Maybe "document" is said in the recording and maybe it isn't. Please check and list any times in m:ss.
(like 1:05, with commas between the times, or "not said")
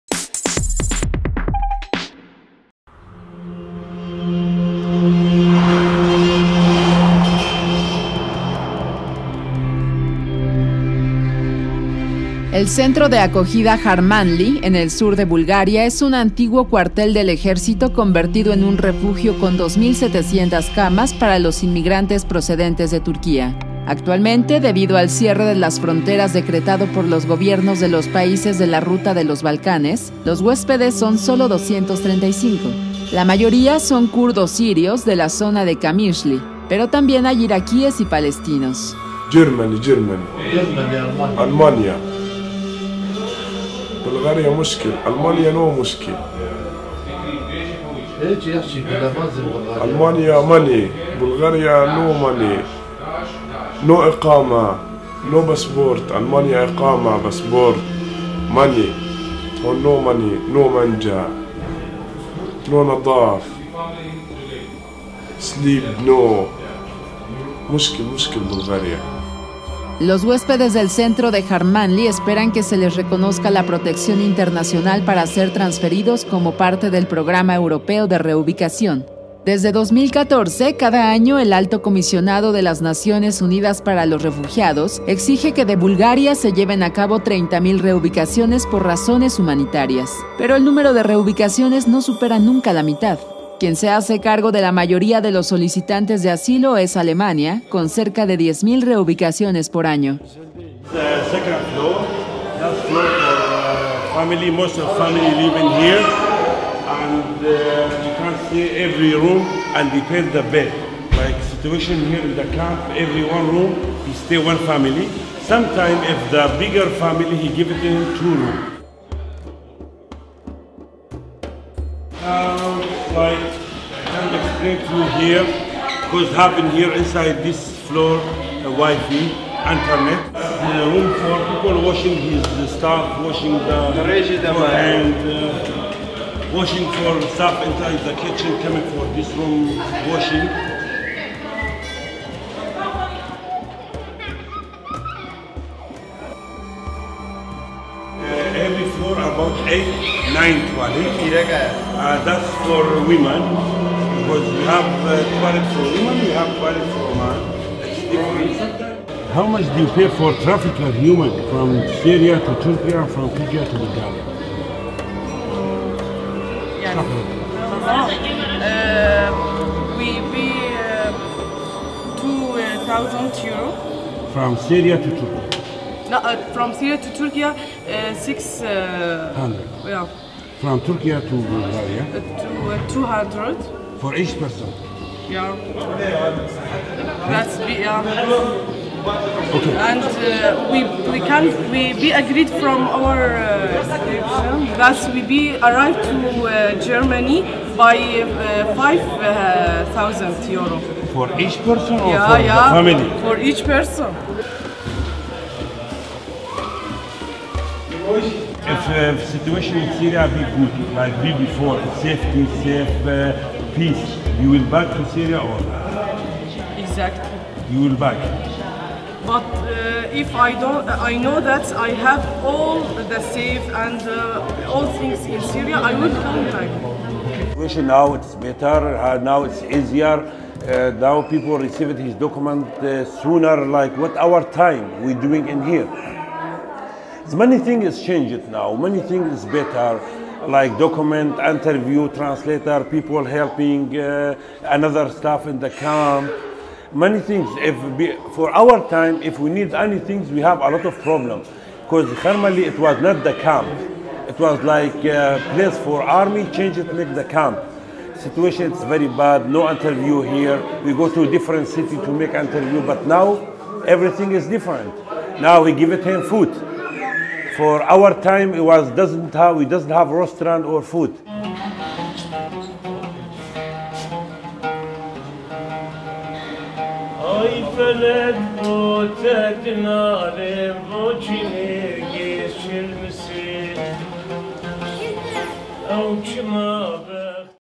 3:52, 4:00.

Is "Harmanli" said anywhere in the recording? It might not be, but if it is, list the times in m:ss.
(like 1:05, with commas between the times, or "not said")
0:13, 1:11.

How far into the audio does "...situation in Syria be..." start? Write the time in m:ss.
3:29.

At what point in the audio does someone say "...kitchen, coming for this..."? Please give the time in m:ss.
2:18.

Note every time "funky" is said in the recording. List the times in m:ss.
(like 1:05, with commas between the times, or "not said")
not said.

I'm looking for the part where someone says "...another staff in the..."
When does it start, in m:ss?
4:04.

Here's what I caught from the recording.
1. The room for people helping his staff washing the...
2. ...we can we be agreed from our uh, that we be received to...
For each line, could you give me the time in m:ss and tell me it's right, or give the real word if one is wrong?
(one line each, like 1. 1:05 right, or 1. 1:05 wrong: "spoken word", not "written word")
1. 2:10 wrong: "washing", not "helping"
2. 3:11 wrong: "arrived", not "received".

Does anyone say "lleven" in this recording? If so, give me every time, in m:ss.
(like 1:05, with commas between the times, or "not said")
1:26.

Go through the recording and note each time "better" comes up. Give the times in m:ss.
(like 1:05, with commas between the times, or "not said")
3:48, 3:59.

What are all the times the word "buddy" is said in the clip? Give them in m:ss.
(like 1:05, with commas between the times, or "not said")
not said.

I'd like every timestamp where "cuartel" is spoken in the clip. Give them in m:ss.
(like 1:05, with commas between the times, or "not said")
0:16.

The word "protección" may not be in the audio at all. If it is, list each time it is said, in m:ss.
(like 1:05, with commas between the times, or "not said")
1:13.